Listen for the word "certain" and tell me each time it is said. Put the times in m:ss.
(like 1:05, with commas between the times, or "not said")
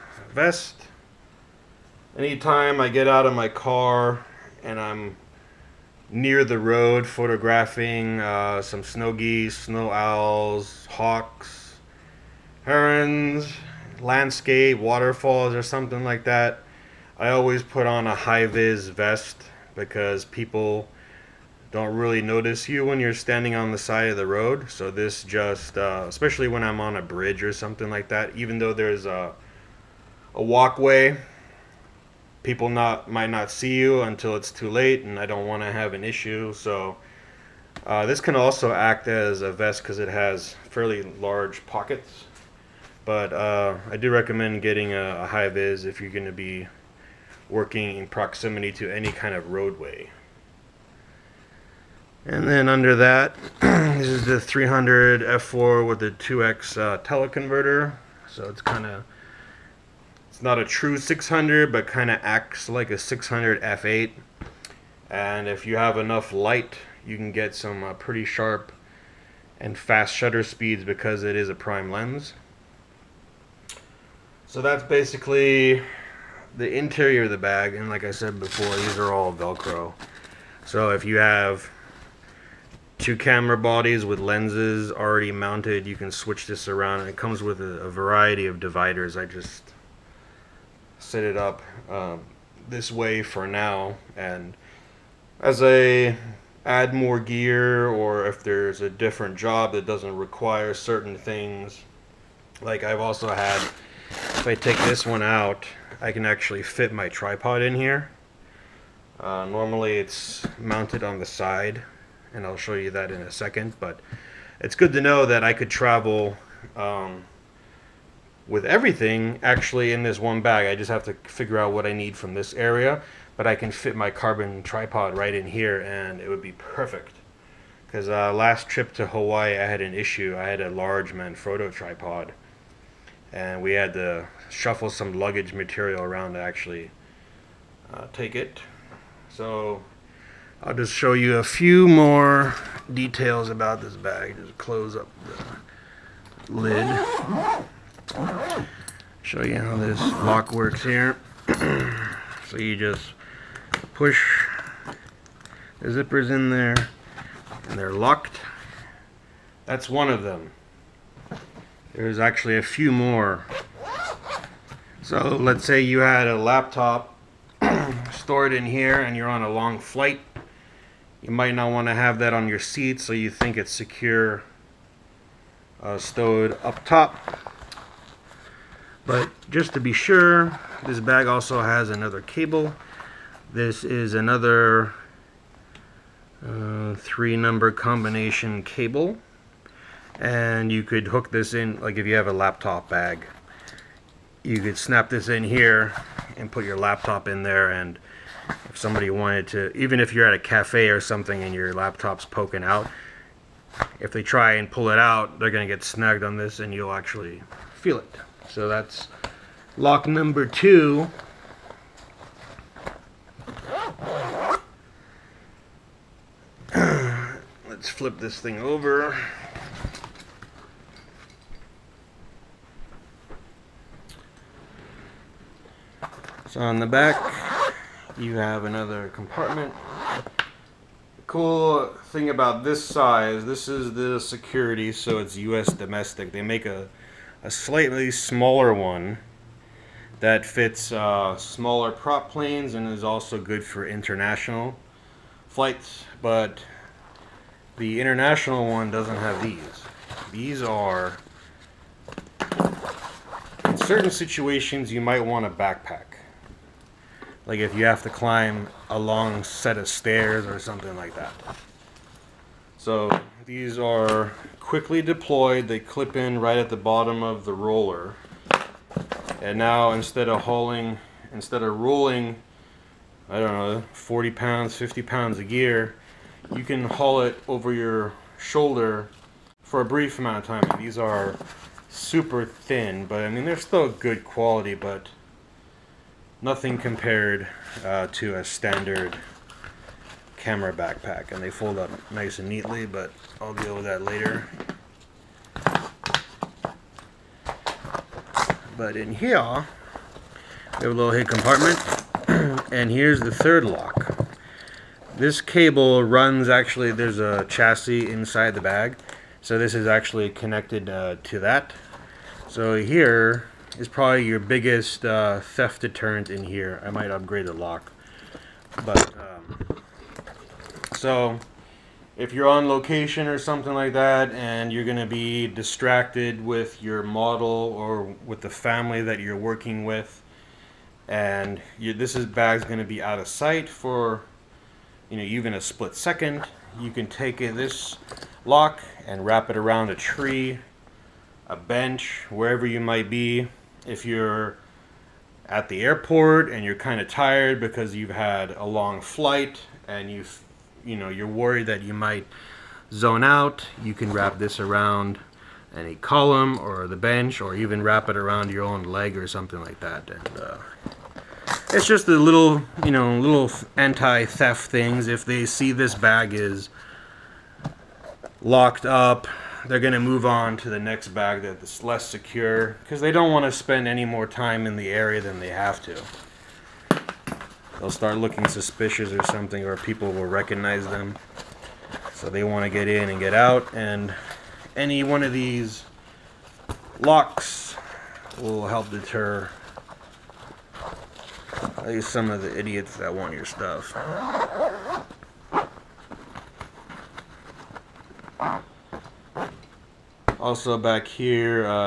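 1:40, 4:13.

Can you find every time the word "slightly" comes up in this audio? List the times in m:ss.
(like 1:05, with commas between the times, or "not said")
3:57.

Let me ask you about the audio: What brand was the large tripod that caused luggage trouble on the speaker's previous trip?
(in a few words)
Manfrotto.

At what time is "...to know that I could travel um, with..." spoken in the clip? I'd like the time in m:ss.
1:54.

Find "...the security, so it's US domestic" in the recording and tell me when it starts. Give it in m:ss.
3:53.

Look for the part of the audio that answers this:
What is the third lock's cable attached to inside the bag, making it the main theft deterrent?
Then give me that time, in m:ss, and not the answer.
5:07.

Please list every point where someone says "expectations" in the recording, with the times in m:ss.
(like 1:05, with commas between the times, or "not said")
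not said.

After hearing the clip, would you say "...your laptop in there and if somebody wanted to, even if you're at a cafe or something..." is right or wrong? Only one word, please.
right.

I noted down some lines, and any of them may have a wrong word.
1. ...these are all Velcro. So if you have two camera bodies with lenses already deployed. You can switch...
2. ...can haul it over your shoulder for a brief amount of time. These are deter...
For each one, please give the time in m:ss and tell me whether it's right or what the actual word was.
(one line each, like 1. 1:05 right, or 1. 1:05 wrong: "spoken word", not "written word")
1. 1:18 wrong: "mounted", not "deployed"
2. 4:36 wrong: "super", not "deter".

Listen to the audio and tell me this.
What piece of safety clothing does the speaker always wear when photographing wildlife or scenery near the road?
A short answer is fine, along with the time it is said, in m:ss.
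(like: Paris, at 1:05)
high vis vest, at 0:18.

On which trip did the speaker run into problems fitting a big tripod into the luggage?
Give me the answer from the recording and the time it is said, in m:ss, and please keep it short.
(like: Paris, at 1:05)
Hawaii, at 2:09.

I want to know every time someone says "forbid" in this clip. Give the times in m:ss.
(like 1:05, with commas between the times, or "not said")
not said.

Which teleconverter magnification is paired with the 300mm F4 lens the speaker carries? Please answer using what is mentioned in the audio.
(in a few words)
2X.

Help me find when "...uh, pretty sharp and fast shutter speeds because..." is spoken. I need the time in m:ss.
1:07.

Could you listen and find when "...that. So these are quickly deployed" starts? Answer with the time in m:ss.
4:21.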